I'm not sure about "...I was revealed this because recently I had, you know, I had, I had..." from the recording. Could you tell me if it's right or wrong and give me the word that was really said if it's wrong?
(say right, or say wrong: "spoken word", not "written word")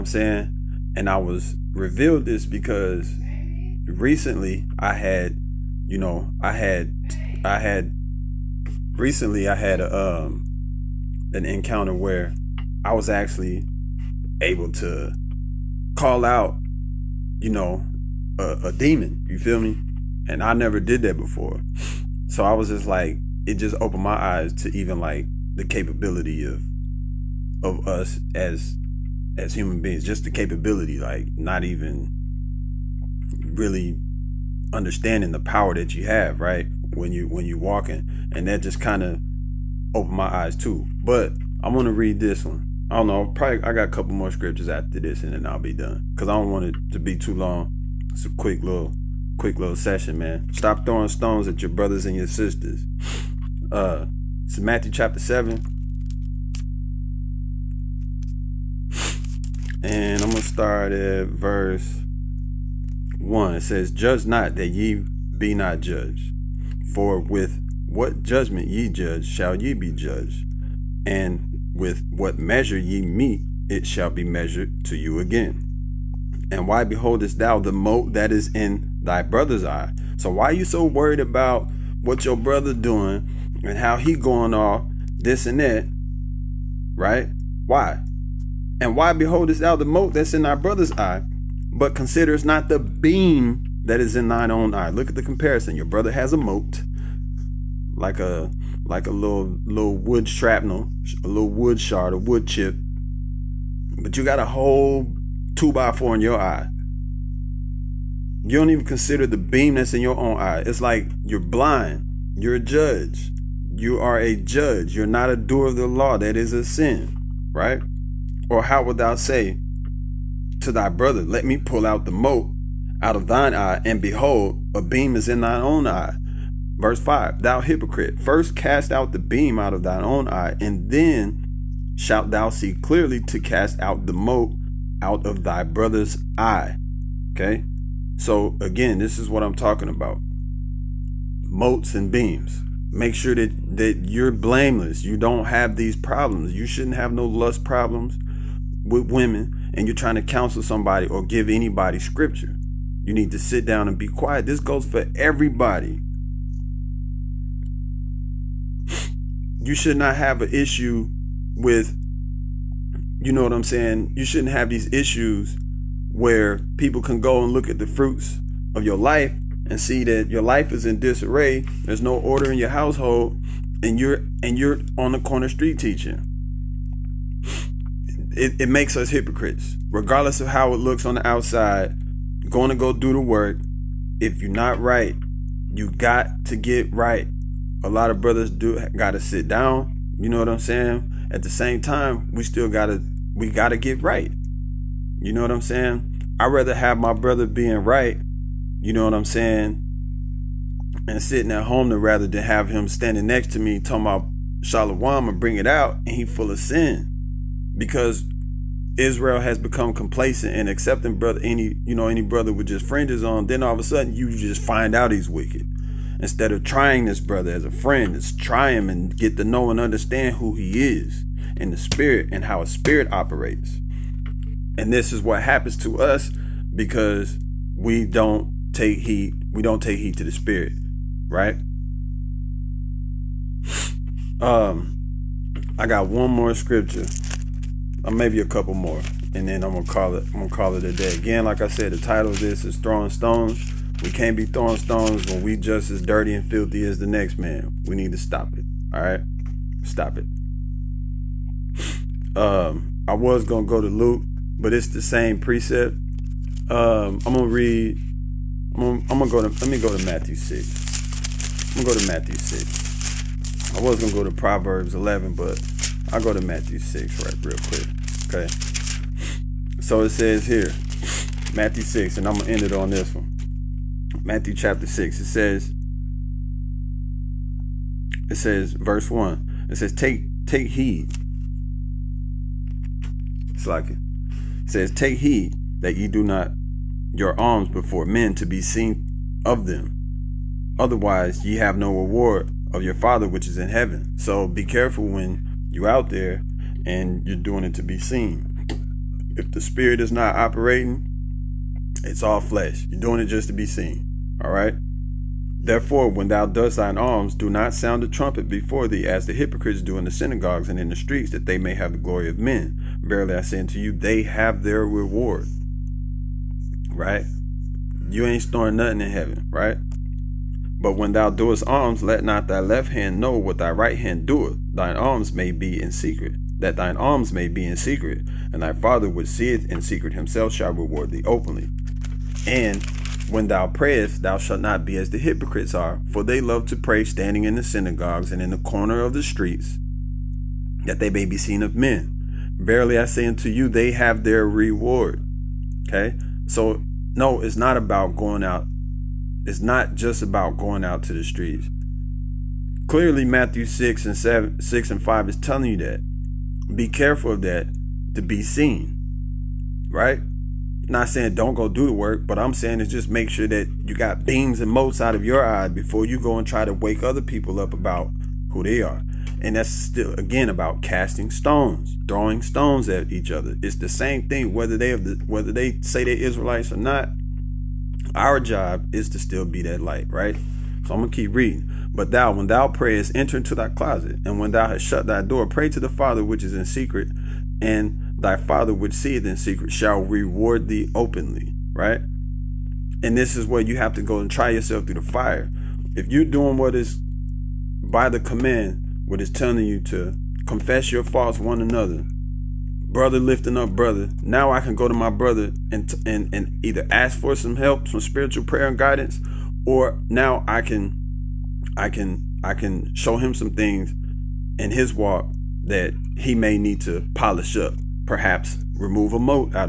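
right.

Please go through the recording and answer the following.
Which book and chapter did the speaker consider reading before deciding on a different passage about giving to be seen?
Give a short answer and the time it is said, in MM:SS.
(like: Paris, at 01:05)
Proverbs 11, at 04:24.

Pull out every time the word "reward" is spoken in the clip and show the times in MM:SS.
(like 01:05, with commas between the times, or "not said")
04:51, 05:14, 05:30, 05:44, 06:29.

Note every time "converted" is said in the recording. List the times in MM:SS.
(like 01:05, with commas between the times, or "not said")
not said.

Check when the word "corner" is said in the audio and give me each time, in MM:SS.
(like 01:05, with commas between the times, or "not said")
02:55, 05:38.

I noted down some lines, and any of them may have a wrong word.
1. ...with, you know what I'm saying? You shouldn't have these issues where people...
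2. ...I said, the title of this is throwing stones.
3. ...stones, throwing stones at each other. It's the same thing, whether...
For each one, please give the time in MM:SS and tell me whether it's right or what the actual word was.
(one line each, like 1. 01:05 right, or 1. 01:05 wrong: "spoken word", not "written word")
1. 02:41 right
2. 04:01 right
3. 06:11 right.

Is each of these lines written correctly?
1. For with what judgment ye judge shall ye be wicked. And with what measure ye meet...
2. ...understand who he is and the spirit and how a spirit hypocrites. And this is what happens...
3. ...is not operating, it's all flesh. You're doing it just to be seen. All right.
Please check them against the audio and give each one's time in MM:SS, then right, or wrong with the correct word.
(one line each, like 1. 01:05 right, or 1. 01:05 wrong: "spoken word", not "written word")
1. 01:06 wrong: "judged", not "wicked"
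2. 03:39 wrong: "operates", not "hypocrites"
3. 04:59 right.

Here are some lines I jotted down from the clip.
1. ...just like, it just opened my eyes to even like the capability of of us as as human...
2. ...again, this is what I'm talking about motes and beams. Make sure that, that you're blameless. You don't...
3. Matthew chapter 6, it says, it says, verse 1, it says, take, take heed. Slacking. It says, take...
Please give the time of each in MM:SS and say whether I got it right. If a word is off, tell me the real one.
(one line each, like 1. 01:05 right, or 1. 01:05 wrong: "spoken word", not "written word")
1. 00:22 right
2. 02:18 right
3. 04:34 right.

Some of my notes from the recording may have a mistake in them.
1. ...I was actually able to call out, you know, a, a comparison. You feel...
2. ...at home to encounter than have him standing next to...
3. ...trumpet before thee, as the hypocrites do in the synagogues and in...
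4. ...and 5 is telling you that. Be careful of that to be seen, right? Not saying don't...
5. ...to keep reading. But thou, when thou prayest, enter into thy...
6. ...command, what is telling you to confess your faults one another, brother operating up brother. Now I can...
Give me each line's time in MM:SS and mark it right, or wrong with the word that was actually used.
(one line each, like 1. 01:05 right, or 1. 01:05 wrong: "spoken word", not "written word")
1. 00:12 wrong: "demon", not "comparison"
2. 03:21 wrong: "rather", not "encounter"
3. 05:08 right
4. 05:54 right
5. 06:21 right
6. 06:38 wrong: "lifting", not "operating".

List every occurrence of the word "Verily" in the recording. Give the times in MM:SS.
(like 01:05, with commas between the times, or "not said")
05:13, 05:42.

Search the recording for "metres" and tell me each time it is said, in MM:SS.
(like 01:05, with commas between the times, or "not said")
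not said.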